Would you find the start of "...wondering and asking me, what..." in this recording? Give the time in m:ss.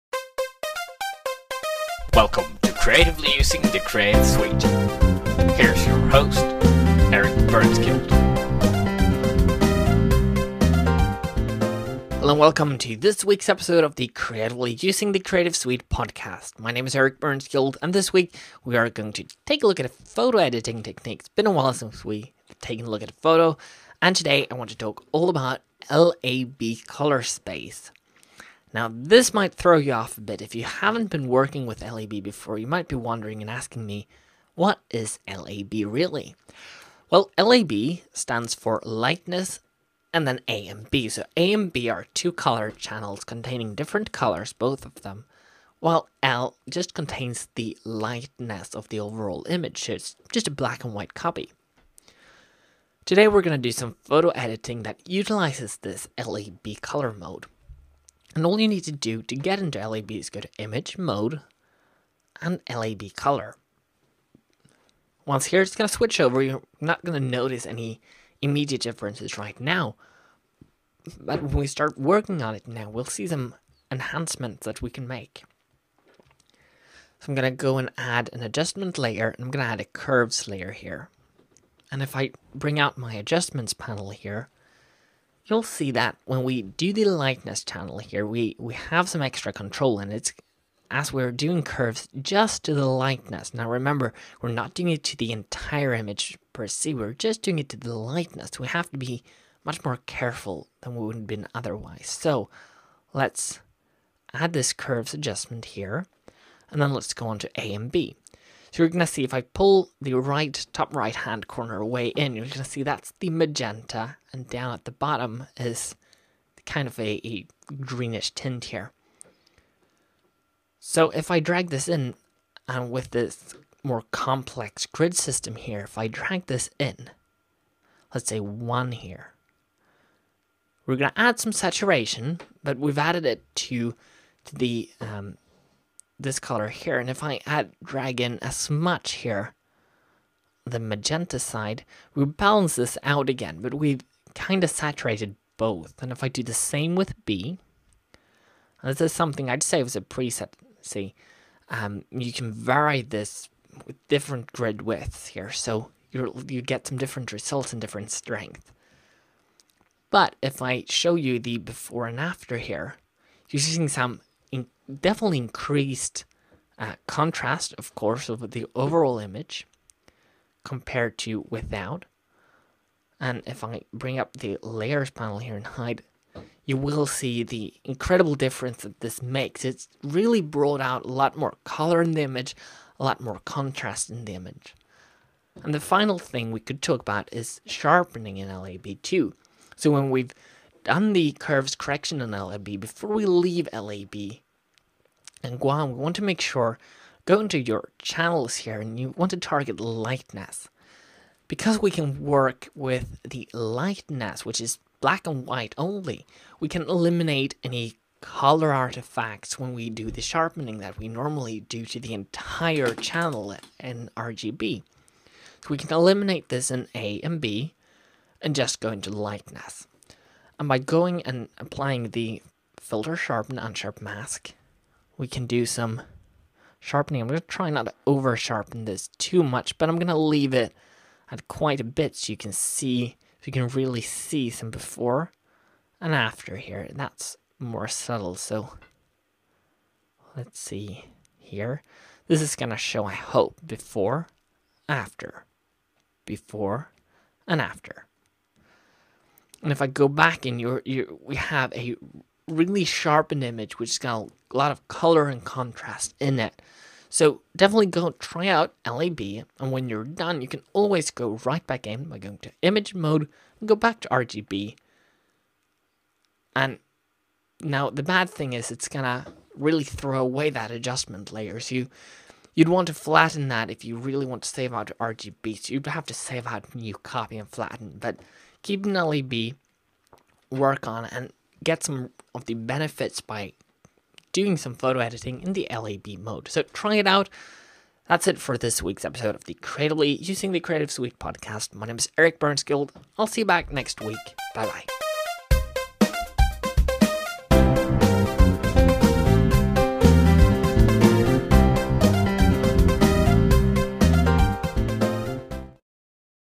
0:32.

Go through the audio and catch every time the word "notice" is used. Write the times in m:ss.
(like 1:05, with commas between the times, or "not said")
1:07.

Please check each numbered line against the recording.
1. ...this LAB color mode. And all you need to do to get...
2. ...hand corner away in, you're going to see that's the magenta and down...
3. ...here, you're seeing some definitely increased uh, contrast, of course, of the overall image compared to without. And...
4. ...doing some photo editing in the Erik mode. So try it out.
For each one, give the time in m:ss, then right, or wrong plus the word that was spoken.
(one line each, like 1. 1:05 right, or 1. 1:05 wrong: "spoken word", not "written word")
1. 0:55 right
2. 1:51 right
3. 2:42 right
4. 4:44 wrong: "LAB", not "Erik".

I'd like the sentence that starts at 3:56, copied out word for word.
and That's more subtle, so let's see here.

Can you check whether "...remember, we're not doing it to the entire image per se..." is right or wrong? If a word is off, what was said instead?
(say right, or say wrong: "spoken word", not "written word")
right.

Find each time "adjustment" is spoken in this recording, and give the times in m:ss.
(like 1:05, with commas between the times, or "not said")
1:18, 1:23, 1:45, 4:30.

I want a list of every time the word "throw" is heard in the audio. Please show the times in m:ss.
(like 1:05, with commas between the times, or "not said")
0:29, 4:29.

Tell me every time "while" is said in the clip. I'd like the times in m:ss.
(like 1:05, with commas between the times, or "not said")
0:21, 0:45.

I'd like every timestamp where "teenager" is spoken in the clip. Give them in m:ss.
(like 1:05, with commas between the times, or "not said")
not said.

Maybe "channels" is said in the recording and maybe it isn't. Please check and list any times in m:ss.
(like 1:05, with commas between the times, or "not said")
0:42, 1:27, 3:17, 3:32.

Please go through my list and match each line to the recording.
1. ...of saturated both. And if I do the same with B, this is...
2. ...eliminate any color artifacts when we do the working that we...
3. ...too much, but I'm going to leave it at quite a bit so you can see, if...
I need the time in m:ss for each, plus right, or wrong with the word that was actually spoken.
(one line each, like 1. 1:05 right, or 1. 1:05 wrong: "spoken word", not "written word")
1. 2:24 right
2. 3:26 wrong: "sharpening", not "working"
3. 3:49 right.